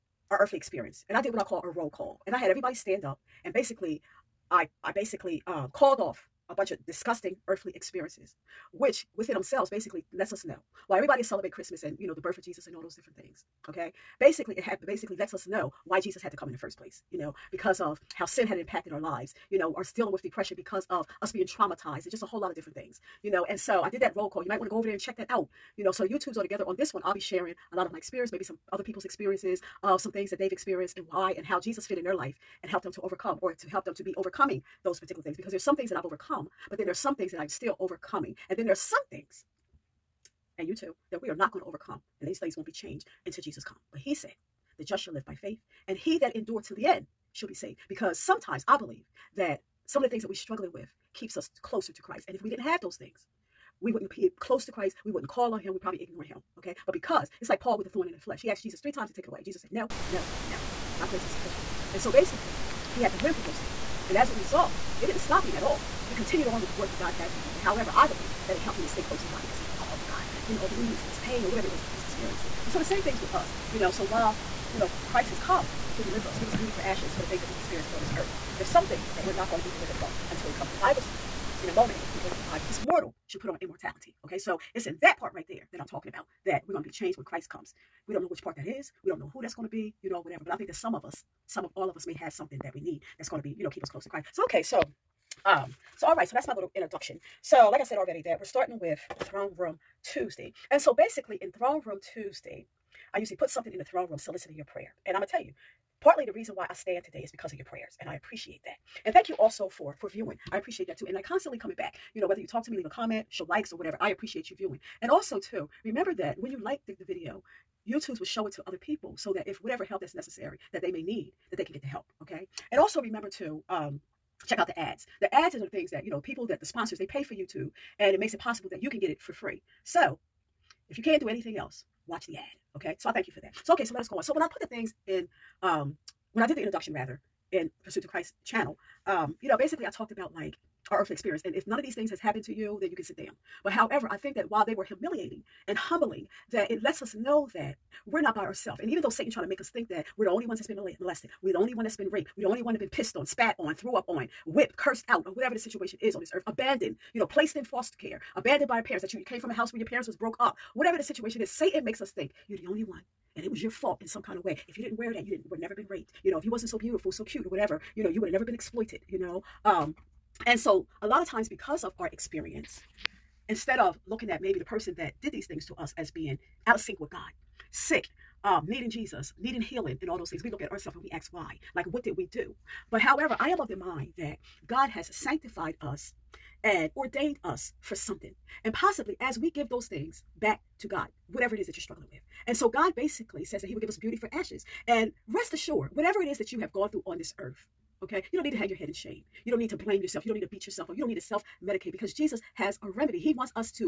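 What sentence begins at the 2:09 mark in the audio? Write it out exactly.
So if you can't do anything else, watch the ad.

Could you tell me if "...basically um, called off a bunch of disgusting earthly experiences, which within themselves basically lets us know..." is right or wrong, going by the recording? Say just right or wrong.
right.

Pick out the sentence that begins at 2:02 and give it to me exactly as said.
And also remember to um, check out the ads.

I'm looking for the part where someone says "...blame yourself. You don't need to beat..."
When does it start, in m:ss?
3:19.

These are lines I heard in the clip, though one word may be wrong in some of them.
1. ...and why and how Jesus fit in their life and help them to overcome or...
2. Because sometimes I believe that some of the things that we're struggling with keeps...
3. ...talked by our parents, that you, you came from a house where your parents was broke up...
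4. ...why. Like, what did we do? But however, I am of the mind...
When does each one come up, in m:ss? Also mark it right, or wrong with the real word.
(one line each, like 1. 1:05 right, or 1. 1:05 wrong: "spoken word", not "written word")
1. 0:30 right
2. 0:47 right
3. 2:38 wrong: "abandoned", not "talked"
4. 3:01 right.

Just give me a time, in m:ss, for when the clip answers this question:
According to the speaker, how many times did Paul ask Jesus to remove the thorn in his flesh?
0:58.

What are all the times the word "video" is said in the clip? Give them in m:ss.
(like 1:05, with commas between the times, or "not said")
1:57.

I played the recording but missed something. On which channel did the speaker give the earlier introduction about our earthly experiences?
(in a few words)
Pursuit to Christ.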